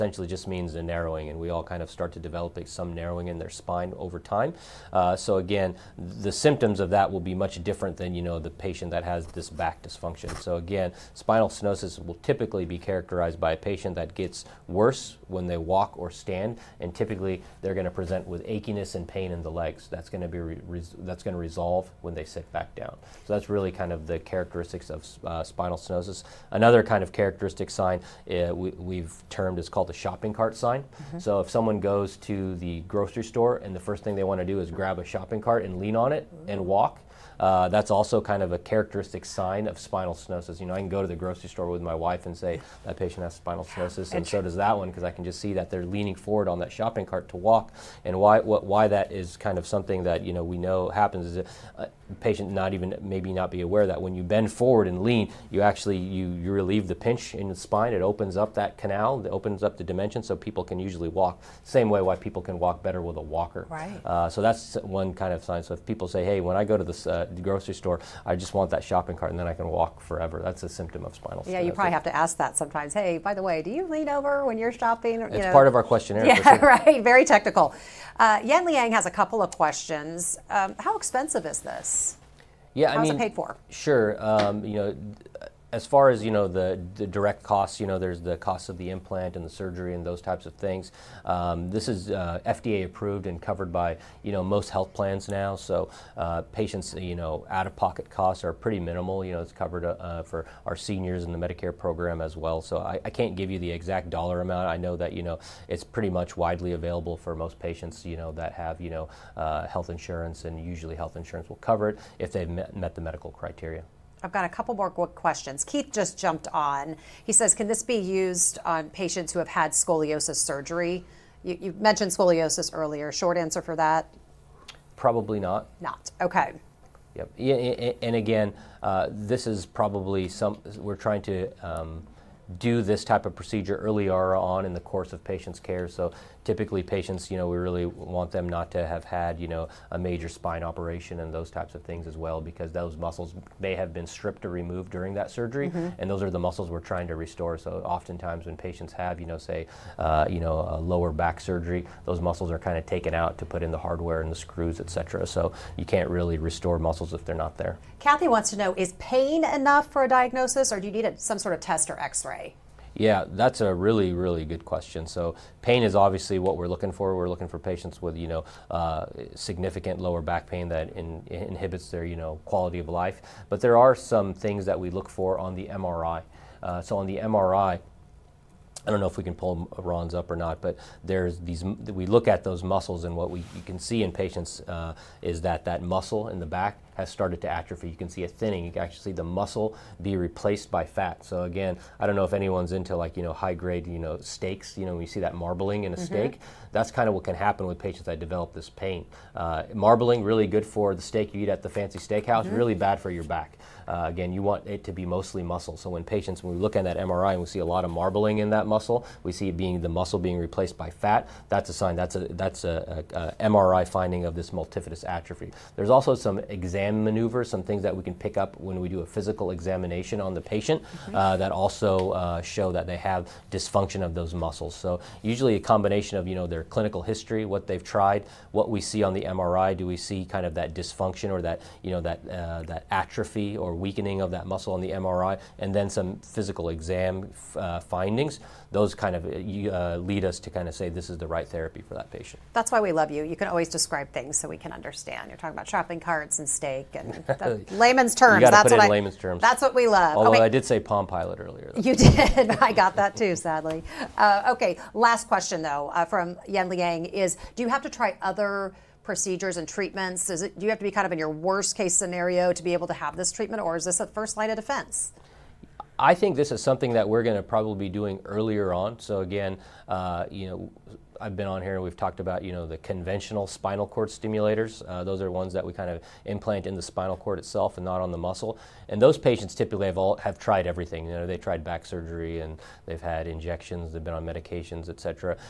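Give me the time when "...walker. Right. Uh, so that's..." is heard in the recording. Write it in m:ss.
1:03.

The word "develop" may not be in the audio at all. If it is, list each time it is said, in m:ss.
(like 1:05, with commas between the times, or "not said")
0:02, 3:18.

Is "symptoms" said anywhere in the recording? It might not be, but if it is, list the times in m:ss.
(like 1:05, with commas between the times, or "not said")
0:06, 1:10.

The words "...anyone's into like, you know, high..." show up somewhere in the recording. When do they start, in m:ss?
3:12.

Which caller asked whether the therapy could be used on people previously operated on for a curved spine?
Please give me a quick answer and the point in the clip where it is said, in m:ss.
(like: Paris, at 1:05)
Keith, at 1:55.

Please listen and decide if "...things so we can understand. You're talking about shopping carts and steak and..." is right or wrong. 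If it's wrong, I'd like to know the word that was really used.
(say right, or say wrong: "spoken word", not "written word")
right.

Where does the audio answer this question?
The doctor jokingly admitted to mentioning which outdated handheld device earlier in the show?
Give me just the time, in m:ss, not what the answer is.
4:10.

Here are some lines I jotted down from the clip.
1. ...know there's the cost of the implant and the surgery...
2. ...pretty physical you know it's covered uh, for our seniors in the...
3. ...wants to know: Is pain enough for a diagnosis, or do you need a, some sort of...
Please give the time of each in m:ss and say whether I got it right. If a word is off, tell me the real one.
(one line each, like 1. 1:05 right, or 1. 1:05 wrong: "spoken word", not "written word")
1. 1:27 right
2. 1:38 wrong: "minimal", not "physical"
3. 2:38 right.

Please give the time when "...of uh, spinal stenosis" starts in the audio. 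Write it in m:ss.
0:24.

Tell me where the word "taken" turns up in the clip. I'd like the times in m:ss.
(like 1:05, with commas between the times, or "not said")
2:32.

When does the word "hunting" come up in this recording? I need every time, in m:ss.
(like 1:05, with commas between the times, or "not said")
not said.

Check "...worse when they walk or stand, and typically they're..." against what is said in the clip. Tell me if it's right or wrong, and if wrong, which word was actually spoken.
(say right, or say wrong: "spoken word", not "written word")
right.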